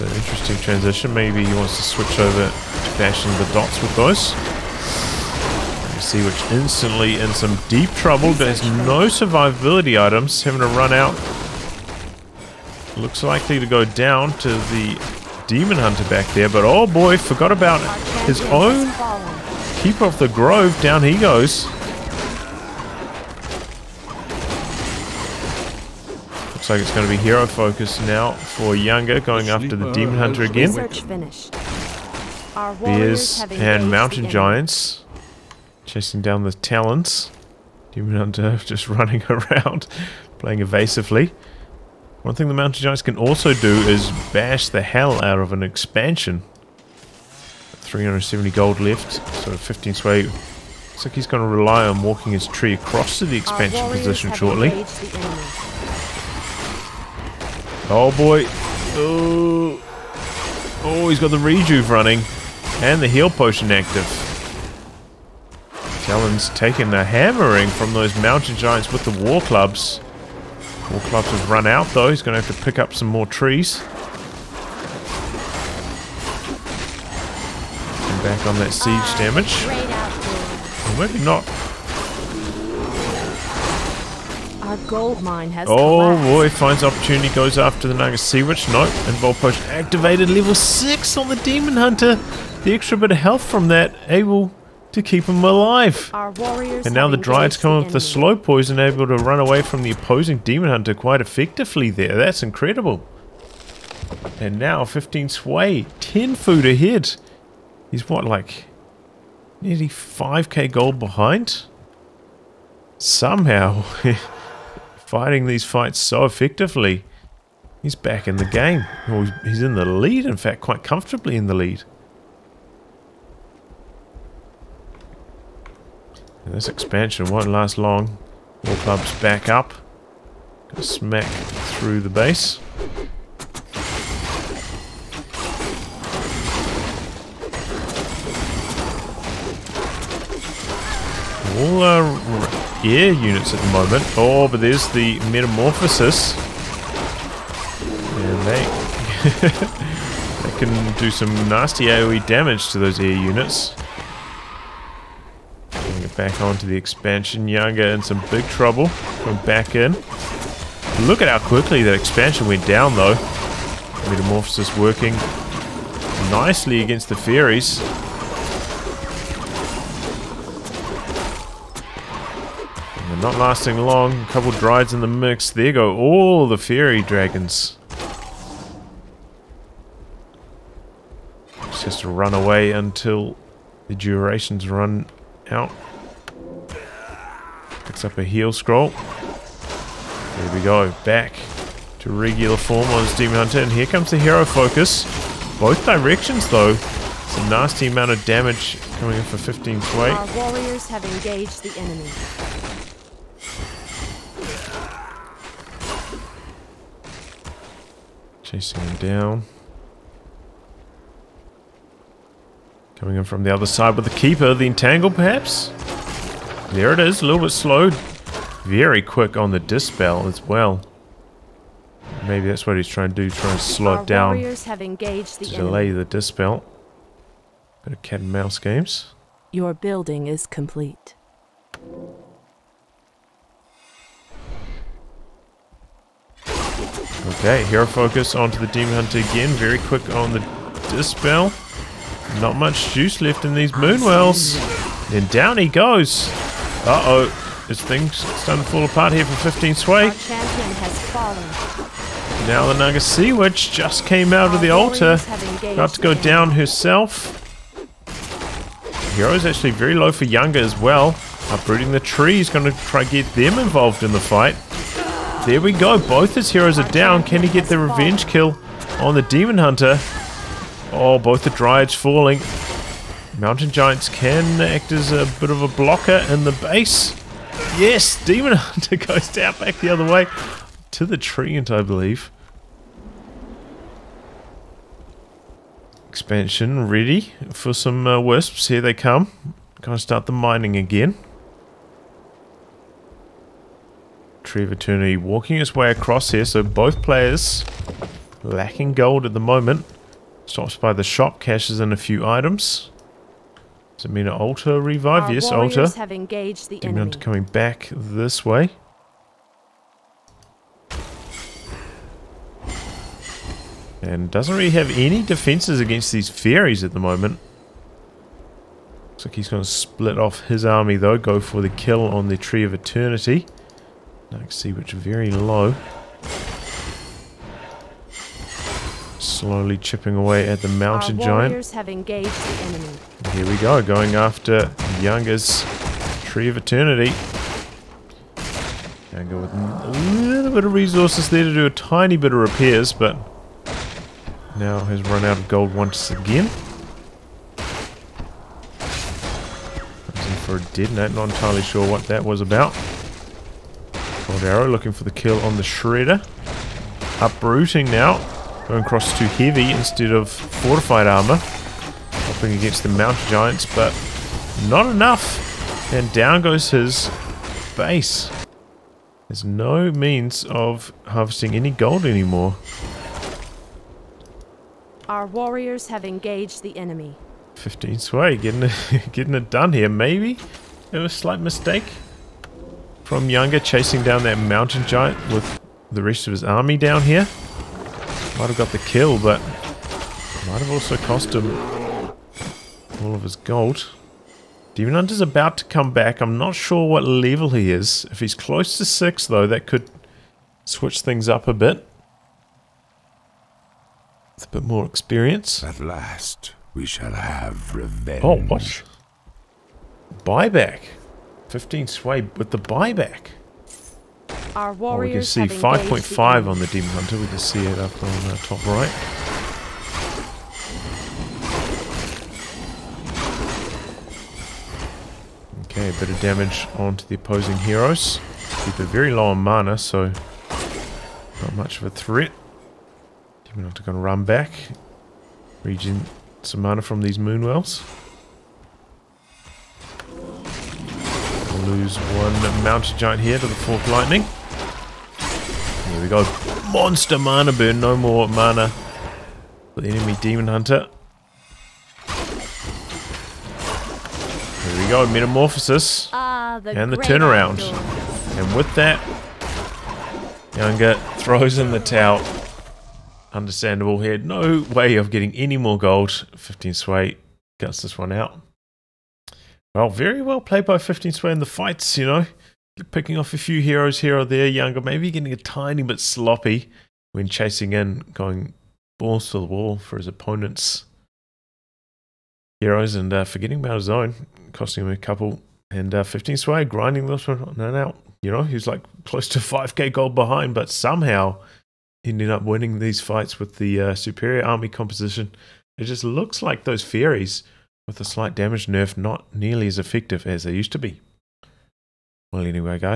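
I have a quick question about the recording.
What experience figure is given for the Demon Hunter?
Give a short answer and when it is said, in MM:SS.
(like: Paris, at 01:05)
5.5, at 06:55.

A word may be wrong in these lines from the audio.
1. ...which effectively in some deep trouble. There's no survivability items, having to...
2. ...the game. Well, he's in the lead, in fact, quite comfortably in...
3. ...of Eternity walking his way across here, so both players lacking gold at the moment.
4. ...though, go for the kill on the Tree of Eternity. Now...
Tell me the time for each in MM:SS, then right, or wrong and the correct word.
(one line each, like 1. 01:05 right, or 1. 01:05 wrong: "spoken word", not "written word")
1. 00:06 wrong: "instantly", not "effectively"
2. 01:58 right
3. 04:54 right
4. 05:20 right.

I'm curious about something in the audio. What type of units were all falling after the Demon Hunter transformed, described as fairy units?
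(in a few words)
Fairy dragons.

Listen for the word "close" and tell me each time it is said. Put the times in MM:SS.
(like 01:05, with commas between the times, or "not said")
06:38, 08:09.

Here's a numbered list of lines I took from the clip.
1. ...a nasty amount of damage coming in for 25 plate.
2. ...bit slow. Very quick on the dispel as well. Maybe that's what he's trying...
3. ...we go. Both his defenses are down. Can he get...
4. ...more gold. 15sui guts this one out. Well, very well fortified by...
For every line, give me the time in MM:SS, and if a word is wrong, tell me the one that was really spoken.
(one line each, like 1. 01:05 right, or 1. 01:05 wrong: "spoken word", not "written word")
1. 03:17 wrong: "15", not "25"
2. 03:37 right
3. 04:25 wrong: "heroes", not "defenses"
4. 07:45 wrong: "played", not "fortified".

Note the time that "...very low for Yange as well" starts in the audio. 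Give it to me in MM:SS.
04:19.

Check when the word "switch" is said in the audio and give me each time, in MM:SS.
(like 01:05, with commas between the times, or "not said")
00:01, 06:40.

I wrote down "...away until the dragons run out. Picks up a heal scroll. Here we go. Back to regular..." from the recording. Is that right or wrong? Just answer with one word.
wrong.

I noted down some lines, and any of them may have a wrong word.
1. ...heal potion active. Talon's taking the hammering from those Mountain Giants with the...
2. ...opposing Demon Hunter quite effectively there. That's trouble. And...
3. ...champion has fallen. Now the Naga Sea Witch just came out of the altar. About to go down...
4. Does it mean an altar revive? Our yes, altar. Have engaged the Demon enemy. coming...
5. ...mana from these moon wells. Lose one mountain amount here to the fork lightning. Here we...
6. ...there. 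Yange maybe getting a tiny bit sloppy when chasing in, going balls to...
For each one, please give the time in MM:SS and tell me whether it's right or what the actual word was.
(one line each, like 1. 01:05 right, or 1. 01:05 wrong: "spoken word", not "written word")
1. 01:03 right
2. 01:39 wrong: "incredible", not "trouble"
3. 04:10 right
4. 05:03 right
5. 07:16 wrong: "giant", not "amount"
6. 07:54 right.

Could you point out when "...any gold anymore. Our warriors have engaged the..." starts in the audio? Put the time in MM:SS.
06:11.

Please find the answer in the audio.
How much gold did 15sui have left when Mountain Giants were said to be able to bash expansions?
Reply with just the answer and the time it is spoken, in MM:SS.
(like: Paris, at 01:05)
370, at 00:47.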